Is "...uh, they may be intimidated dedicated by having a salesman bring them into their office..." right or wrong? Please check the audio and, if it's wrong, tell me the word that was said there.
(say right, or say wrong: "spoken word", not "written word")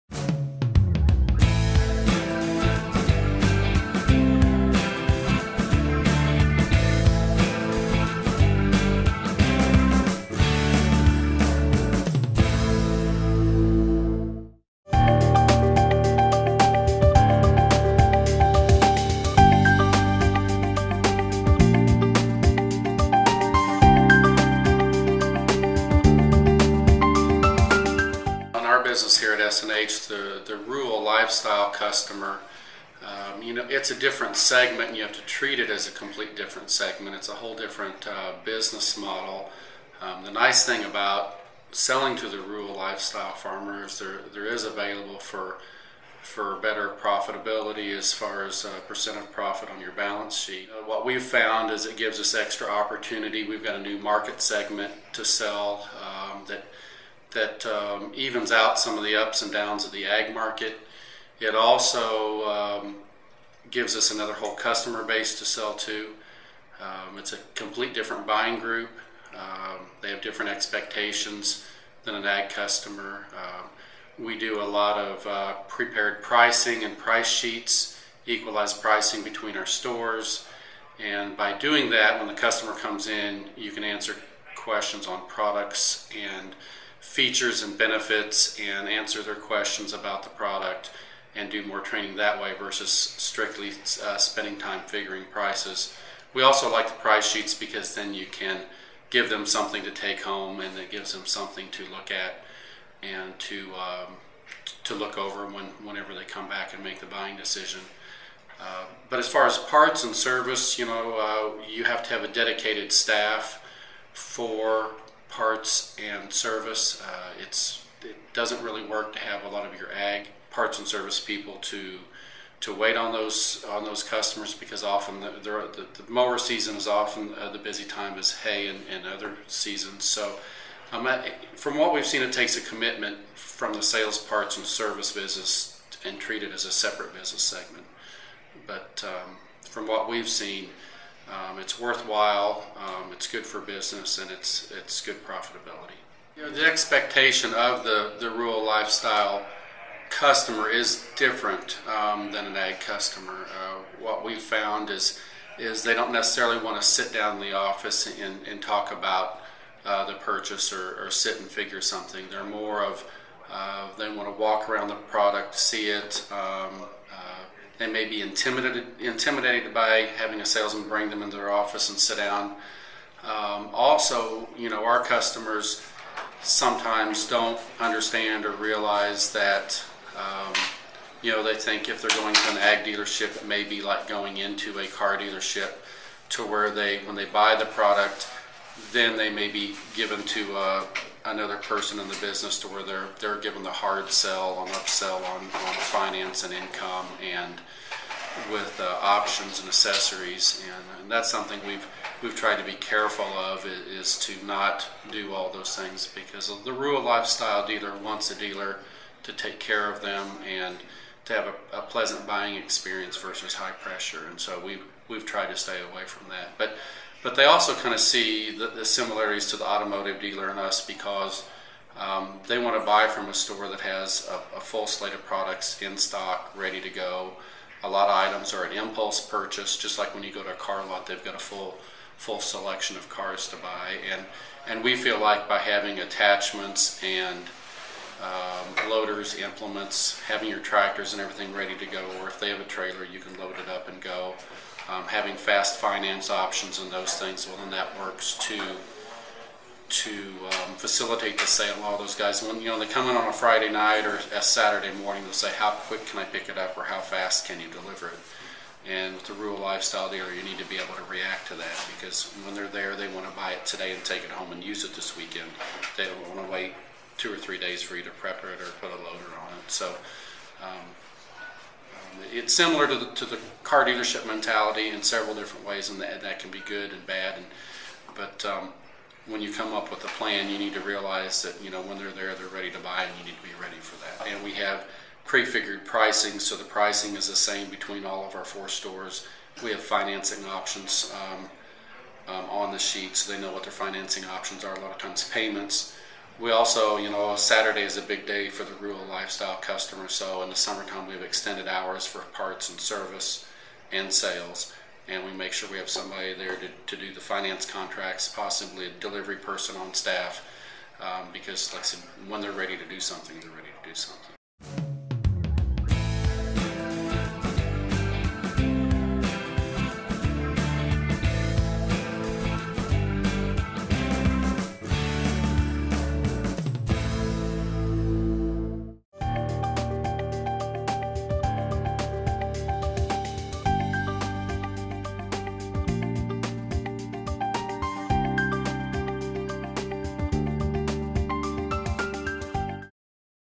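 wrong: "intimidated", not "dedicated".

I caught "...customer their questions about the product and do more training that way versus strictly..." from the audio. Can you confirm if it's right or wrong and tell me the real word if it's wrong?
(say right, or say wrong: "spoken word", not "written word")
wrong: "answer", not "customer".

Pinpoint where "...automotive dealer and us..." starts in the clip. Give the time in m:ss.
3:39.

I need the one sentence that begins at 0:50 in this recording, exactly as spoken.
Uh, what we've found is it gives us extra opportunity.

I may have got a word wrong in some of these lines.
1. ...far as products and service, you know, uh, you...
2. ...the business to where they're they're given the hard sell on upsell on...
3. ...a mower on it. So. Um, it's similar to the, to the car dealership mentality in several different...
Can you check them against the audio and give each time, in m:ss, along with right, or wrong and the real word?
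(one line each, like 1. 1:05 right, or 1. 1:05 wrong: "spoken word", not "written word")
1. 1:49 wrong: "parts", not "products"
2. 3:12 right
3. 4:28 wrong: "loader", not "mower".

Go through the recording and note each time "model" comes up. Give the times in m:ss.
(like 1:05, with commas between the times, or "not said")
0:38.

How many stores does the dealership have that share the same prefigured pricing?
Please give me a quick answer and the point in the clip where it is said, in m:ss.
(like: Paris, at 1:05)
4, at 4:48.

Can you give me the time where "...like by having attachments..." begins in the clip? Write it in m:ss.
3:55.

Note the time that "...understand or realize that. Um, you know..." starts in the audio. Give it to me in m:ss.
2:57.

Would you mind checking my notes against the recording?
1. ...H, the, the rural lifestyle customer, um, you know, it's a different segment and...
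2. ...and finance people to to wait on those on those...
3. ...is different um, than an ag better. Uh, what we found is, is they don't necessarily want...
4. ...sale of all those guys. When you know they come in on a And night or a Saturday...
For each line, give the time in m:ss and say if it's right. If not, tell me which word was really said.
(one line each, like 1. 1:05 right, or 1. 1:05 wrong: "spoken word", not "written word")
1. 0:29 right
2. 2:00 wrong: "service", not "finance"
3. 2:30 wrong: "customer", not "better"
4. 4:11 wrong: "Friday", not "And".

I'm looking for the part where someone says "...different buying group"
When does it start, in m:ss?
1:07.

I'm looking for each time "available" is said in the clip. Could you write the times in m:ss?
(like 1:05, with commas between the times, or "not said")
0:44.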